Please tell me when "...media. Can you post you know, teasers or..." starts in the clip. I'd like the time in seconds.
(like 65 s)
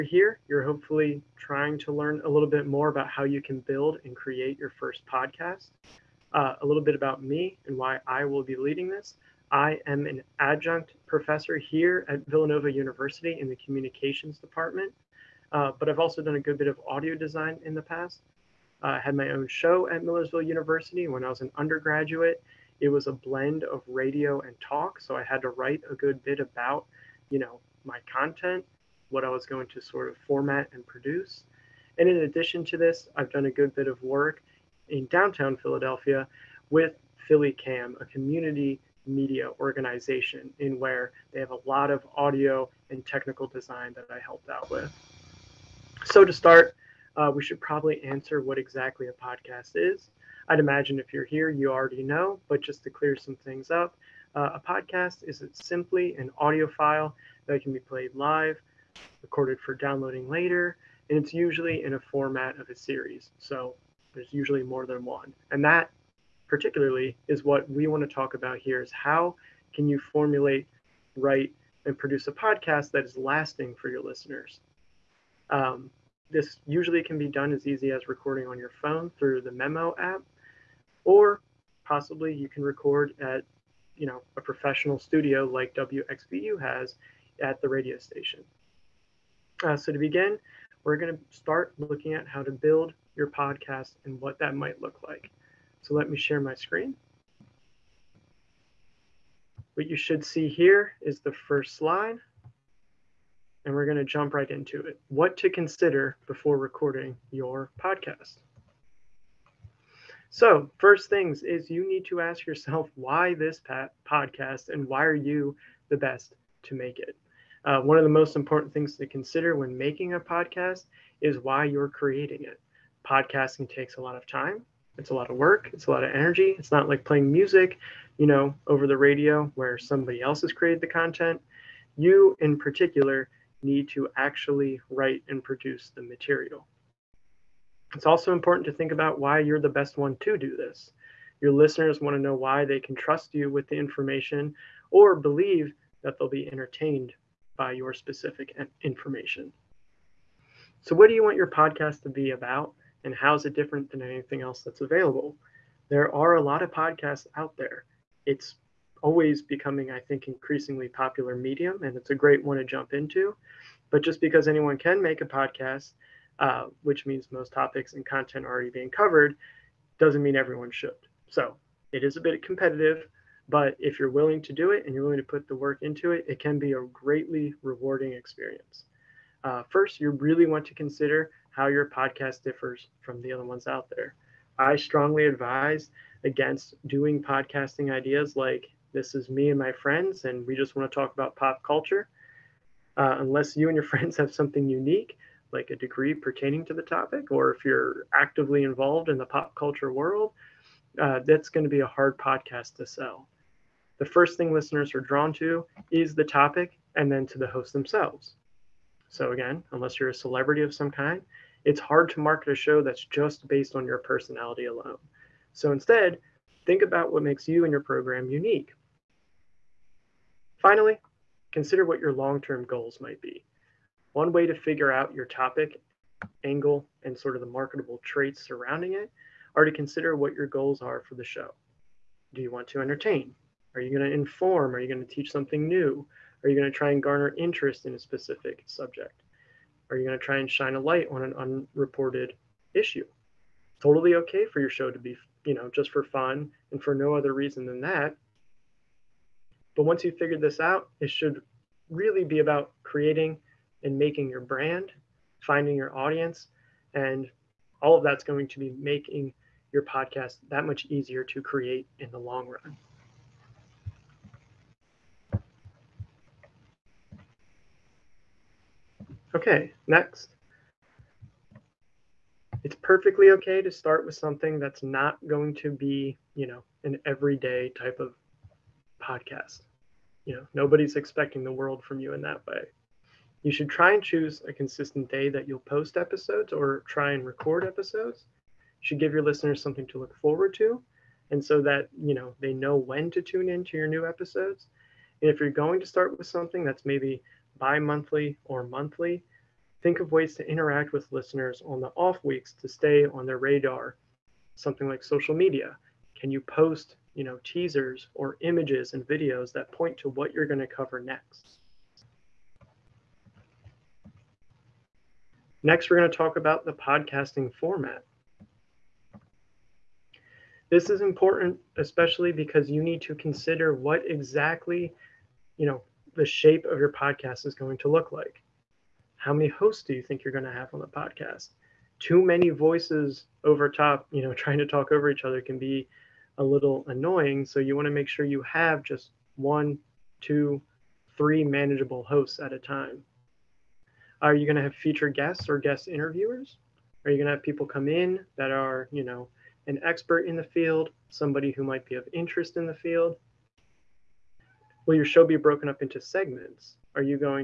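305 s.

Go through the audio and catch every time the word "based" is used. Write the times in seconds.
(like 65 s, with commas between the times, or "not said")
213 s.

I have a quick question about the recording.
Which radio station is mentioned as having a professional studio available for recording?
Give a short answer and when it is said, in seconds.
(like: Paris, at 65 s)
WXVU, at 85 s.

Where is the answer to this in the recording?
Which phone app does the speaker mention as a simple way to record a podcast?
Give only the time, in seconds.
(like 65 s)
79 s.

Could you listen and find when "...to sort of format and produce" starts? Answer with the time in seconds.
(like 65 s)
29 s.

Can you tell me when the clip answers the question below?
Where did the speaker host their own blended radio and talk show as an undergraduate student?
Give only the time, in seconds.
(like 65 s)
20 s.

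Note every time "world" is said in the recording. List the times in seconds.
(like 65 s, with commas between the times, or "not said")
199 s, 281 s.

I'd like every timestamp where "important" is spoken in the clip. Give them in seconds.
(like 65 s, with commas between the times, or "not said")
118 s, 138 s, 321 s.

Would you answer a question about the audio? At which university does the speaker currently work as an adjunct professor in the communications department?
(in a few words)
Villanova University.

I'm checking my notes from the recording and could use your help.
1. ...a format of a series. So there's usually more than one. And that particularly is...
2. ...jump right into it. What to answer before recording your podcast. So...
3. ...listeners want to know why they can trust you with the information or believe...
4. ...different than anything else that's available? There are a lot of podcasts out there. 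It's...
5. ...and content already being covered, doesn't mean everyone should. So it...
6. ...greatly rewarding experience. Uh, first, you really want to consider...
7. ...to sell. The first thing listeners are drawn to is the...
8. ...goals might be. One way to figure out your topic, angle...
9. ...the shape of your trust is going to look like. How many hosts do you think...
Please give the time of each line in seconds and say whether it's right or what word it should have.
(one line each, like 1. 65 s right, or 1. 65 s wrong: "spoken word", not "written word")
1. 61 s right
2. 104 s wrong: "consider", not "answer"
3. 141 s right
4. 153 s right
5. 167 s right
6. 176 s right
7. 202 s right
8. 222 s right
9. 326 s wrong: "podcast", not "trust".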